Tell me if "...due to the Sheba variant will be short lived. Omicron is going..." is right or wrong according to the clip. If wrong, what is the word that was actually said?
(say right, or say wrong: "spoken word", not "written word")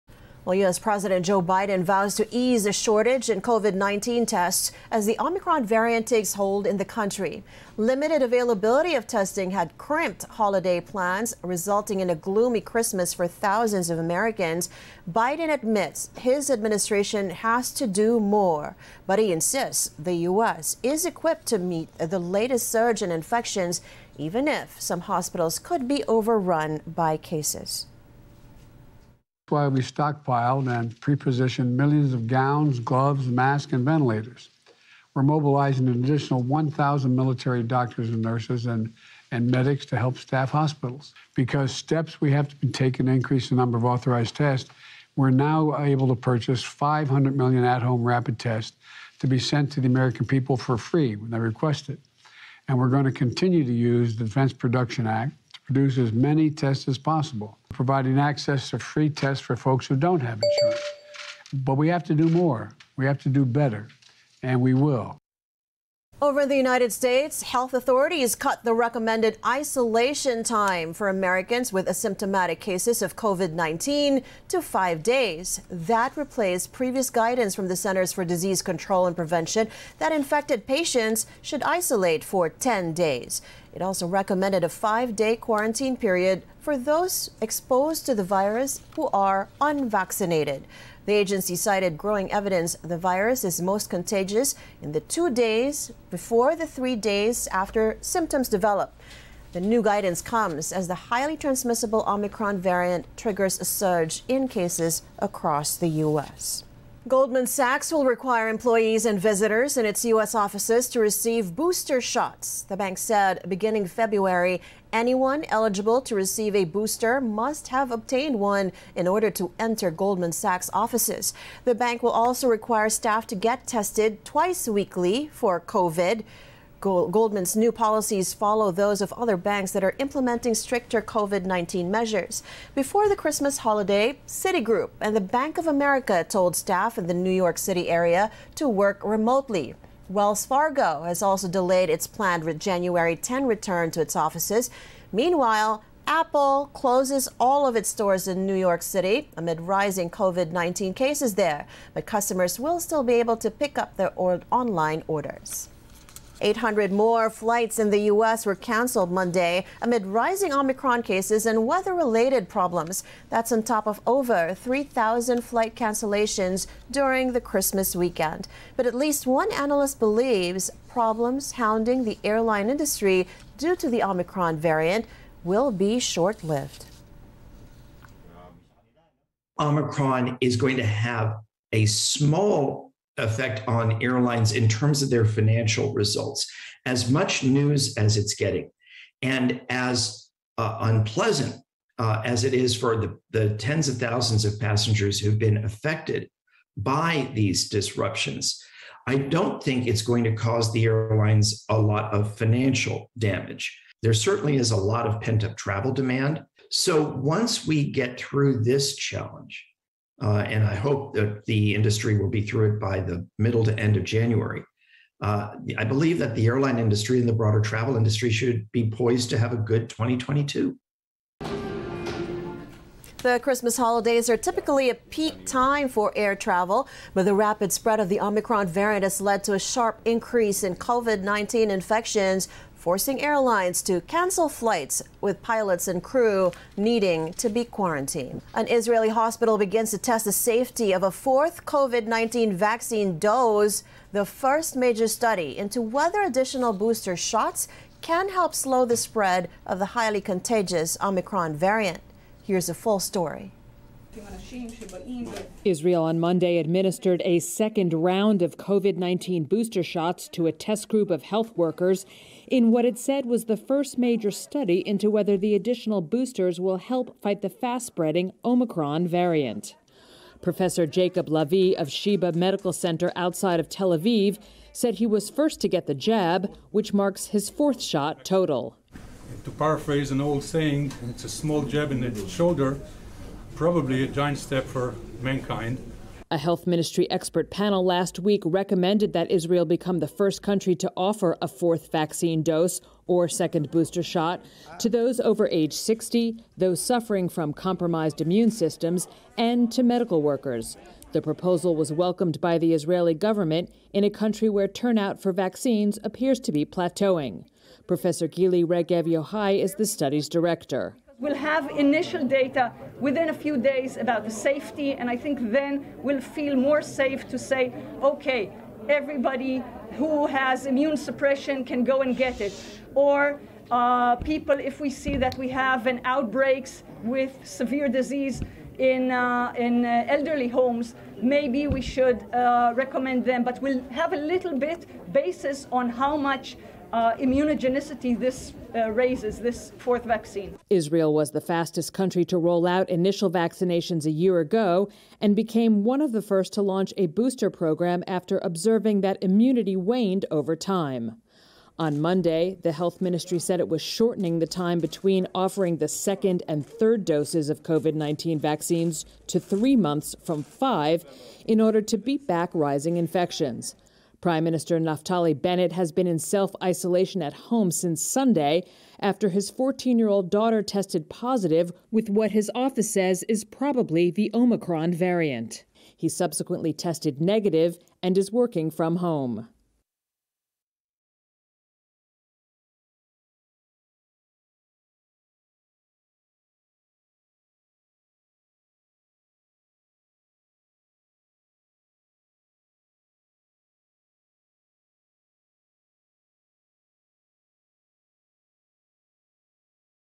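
wrong: "Omicron", not "Sheba".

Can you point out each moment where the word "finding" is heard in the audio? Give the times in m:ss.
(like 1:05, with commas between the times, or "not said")
not said.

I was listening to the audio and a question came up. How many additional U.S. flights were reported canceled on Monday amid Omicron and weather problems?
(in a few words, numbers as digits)
800.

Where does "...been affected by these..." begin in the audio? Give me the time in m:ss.
3:15.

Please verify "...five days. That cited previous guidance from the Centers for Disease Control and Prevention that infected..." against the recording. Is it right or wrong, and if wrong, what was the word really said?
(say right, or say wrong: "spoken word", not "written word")
wrong: "replaced", not "cited".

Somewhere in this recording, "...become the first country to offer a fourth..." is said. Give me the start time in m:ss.
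4:49.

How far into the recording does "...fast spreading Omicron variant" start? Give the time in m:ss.
4:27.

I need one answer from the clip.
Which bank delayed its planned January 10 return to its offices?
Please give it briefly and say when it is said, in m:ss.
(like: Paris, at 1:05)
Wells Fargo, at 2:20.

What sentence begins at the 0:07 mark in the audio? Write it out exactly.
Limited availability of testing had crimped holiday plans, resulting in a gloomy Christmas for thousands of Americans.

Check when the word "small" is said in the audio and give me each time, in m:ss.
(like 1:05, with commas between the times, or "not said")
3:01, 4:41.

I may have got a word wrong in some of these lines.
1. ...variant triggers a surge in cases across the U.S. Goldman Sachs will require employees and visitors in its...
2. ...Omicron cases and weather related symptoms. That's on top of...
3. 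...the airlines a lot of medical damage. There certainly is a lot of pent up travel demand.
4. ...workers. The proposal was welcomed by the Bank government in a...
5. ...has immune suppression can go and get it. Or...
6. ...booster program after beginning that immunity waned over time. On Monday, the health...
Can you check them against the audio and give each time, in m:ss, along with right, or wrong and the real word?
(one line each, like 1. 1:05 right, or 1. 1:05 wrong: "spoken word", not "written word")
1. 1:42 right
2. 2:40 wrong: "problems", not "symptoms"
3. 3:20 wrong: "financial", not "medical"
4. 5:00 wrong: "Israeli", not "Bank"
5. 5:20 right
6. 5:47 wrong: "observing", not "beginning".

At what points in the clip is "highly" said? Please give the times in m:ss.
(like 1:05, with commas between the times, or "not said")
1:41, 4:09.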